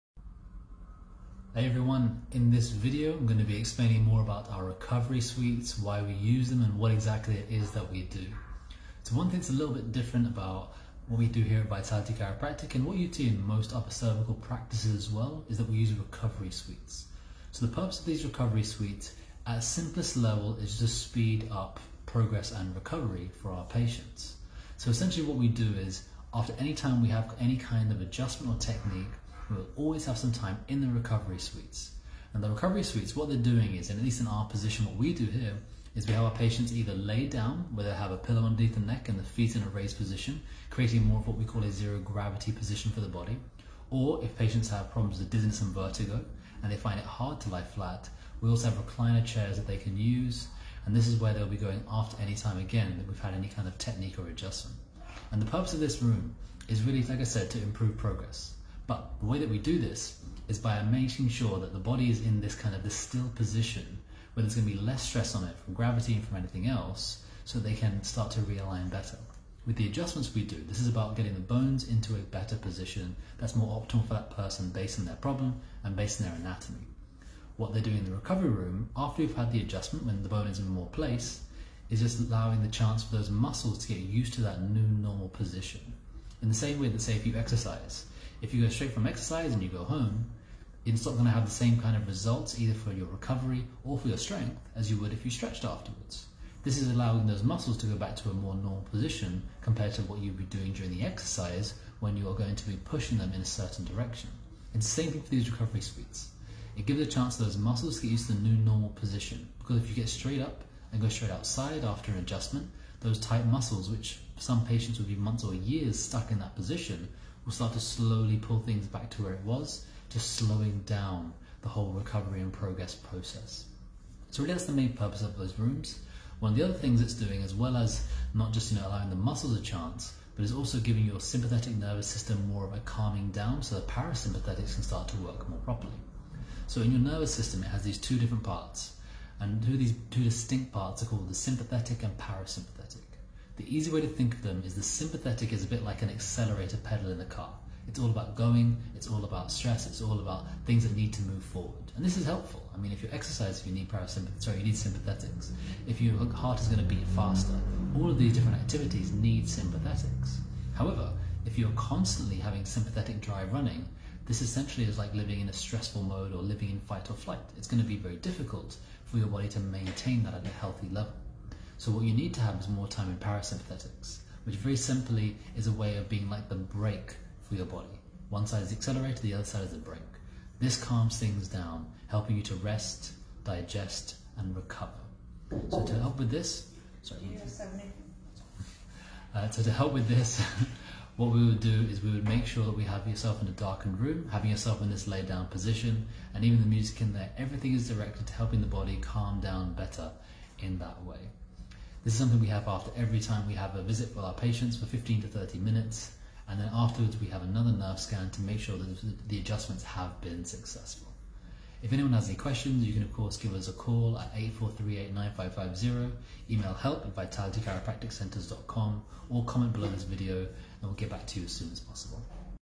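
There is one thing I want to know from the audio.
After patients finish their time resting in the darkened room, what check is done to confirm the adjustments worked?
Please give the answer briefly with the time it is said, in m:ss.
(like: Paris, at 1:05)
nerve scan, at 3:27.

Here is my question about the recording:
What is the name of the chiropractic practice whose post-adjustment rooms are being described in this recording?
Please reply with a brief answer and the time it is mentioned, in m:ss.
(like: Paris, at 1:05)
Vitality Chiropractic, at 0:11.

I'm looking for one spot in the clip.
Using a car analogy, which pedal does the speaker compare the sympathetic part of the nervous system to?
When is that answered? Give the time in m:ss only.
2:26.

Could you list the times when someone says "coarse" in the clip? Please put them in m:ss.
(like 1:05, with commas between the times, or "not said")
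not said.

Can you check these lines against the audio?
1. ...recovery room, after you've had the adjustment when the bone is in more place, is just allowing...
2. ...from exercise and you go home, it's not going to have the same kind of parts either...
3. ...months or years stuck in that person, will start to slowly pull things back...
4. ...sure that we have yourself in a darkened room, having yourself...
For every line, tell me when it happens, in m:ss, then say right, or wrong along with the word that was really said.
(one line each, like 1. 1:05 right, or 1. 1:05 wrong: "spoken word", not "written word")
1. 1:18 right
2. 1:28 wrong: "results", not "parts"
3. 1:55 wrong: "position", not "person"
4. 3:12 right.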